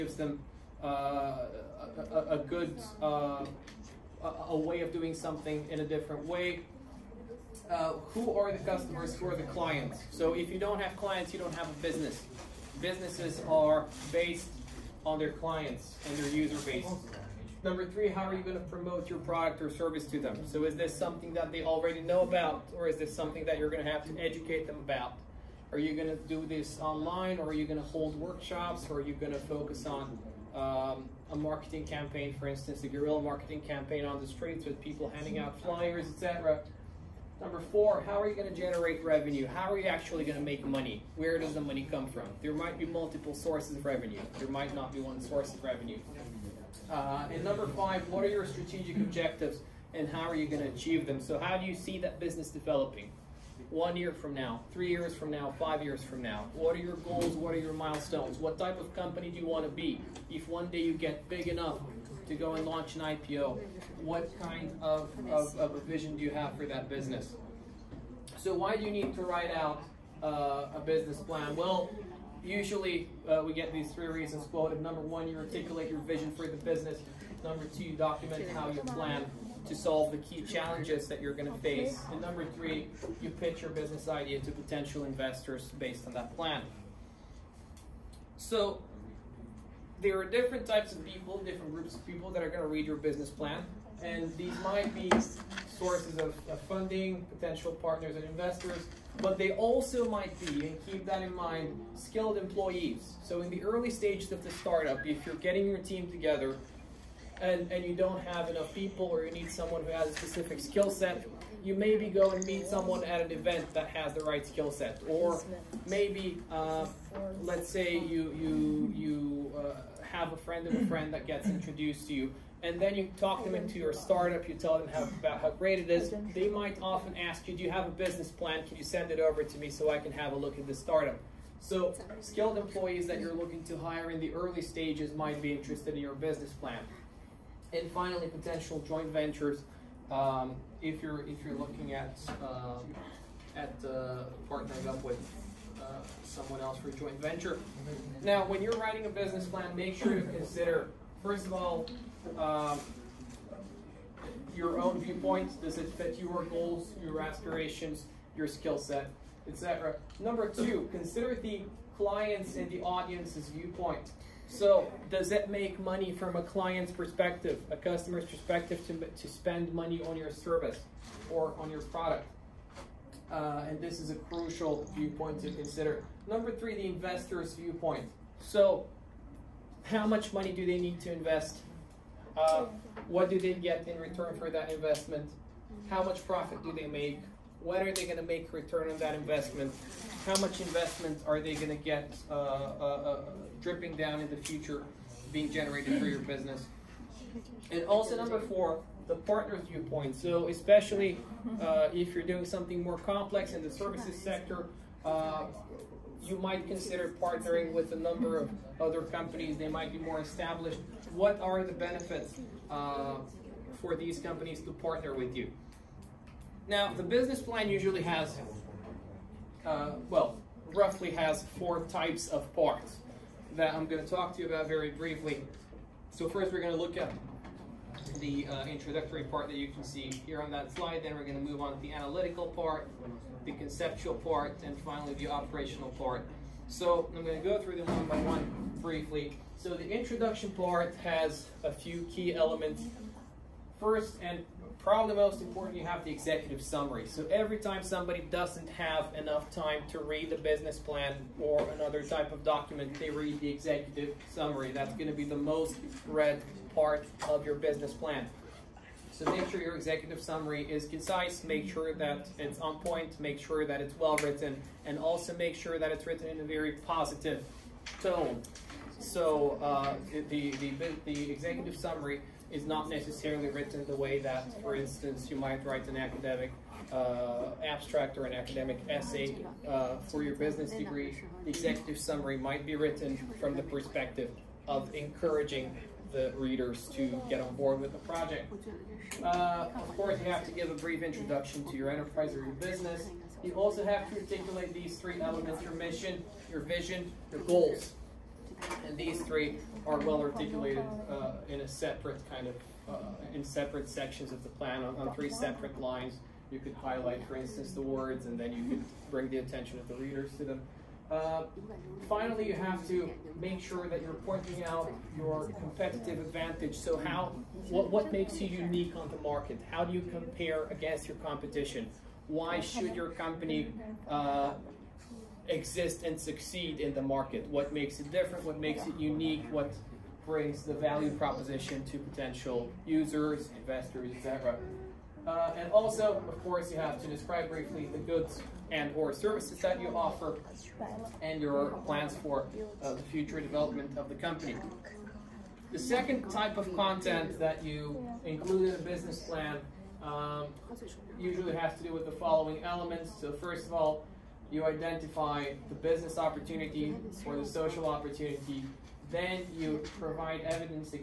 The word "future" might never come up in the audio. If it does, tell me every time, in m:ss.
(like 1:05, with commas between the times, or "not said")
3:14, 5:43.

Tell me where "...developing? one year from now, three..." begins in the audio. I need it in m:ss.
0:52.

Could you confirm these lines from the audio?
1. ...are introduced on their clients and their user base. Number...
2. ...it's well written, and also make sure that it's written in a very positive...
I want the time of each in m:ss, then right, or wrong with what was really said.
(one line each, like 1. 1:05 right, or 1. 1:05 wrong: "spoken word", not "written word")
1. 0:13 wrong: "based", not "introduced"
2. 4:23 right.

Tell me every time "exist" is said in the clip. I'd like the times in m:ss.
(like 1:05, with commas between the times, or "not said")
5:25.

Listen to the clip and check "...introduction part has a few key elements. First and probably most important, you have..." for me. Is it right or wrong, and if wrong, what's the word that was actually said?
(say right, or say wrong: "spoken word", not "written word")
right.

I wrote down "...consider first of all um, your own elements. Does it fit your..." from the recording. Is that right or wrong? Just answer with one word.
wrong.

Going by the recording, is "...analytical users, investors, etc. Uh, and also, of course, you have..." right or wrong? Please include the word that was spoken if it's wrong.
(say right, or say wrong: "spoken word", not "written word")
wrong: "potential", not "analytical".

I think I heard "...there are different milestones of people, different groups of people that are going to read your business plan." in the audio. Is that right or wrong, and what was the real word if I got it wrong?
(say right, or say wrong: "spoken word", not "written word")
wrong: "types", not "milestones".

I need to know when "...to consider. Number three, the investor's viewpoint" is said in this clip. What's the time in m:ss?
2:55.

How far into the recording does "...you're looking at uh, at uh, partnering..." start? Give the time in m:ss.
2:21.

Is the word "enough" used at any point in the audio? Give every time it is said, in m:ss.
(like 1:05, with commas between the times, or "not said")
1:01, 1:48, 4:09.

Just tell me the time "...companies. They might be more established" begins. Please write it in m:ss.
3:29.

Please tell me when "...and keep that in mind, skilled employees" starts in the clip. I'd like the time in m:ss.
1:40.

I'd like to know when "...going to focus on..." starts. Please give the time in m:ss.
0:29.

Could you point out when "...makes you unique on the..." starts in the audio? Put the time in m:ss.
5:18.